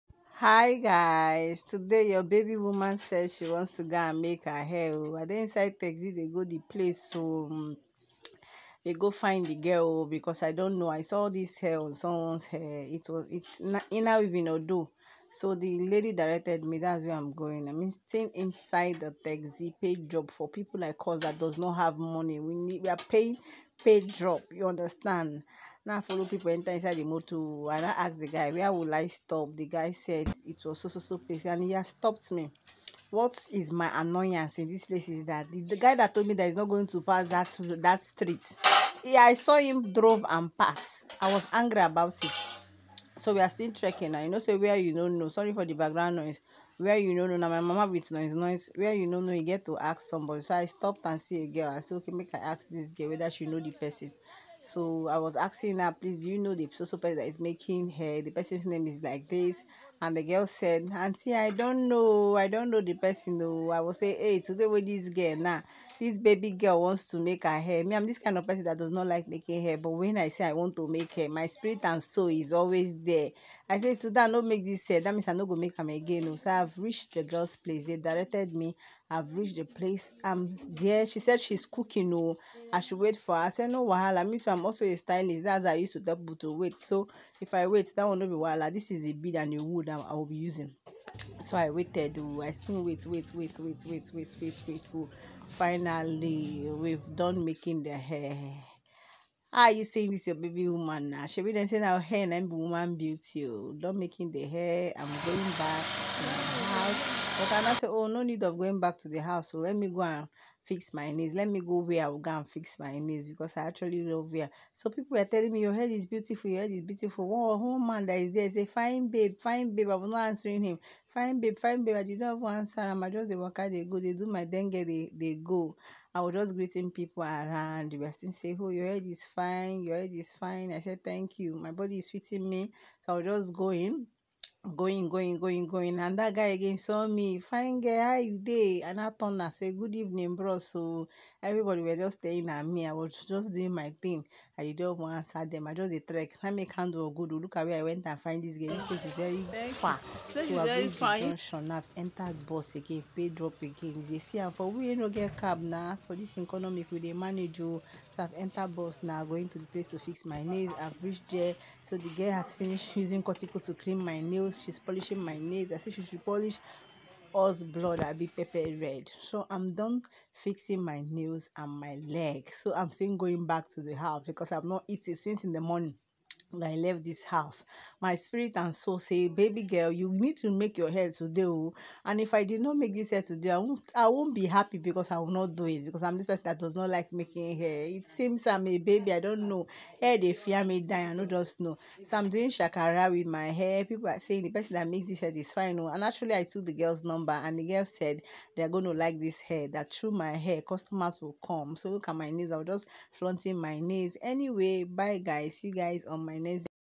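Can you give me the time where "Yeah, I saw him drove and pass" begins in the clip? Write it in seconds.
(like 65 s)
39 s.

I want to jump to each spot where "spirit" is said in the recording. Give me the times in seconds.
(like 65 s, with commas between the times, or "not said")
71 s, 178 s.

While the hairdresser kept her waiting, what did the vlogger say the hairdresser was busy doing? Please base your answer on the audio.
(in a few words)
cooking.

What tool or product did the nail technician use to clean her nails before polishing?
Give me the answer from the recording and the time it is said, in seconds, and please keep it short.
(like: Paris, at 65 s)
cortico, at 163 s.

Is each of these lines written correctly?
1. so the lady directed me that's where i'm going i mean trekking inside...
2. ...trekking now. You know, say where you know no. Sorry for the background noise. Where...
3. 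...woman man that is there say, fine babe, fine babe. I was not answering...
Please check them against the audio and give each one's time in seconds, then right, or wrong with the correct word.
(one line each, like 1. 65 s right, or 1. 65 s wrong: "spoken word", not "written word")
1. 15 s wrong: "staying", not "trekking"
2. 43 s right
3. 117 s right.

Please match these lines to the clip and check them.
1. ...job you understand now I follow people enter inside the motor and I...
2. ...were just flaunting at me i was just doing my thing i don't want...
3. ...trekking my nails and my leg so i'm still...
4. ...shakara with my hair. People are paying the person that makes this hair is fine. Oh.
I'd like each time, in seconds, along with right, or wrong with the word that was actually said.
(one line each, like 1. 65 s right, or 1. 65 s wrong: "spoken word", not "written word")
1. 24 s right
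2. 141 s wrong: "staring", not "flaunting"
3. 170 s wrong: "fixing", not "trekking"
4. 192 s wrong: "saying", not "paying".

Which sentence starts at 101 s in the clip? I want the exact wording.
She be then saying now hair and be woman beauty.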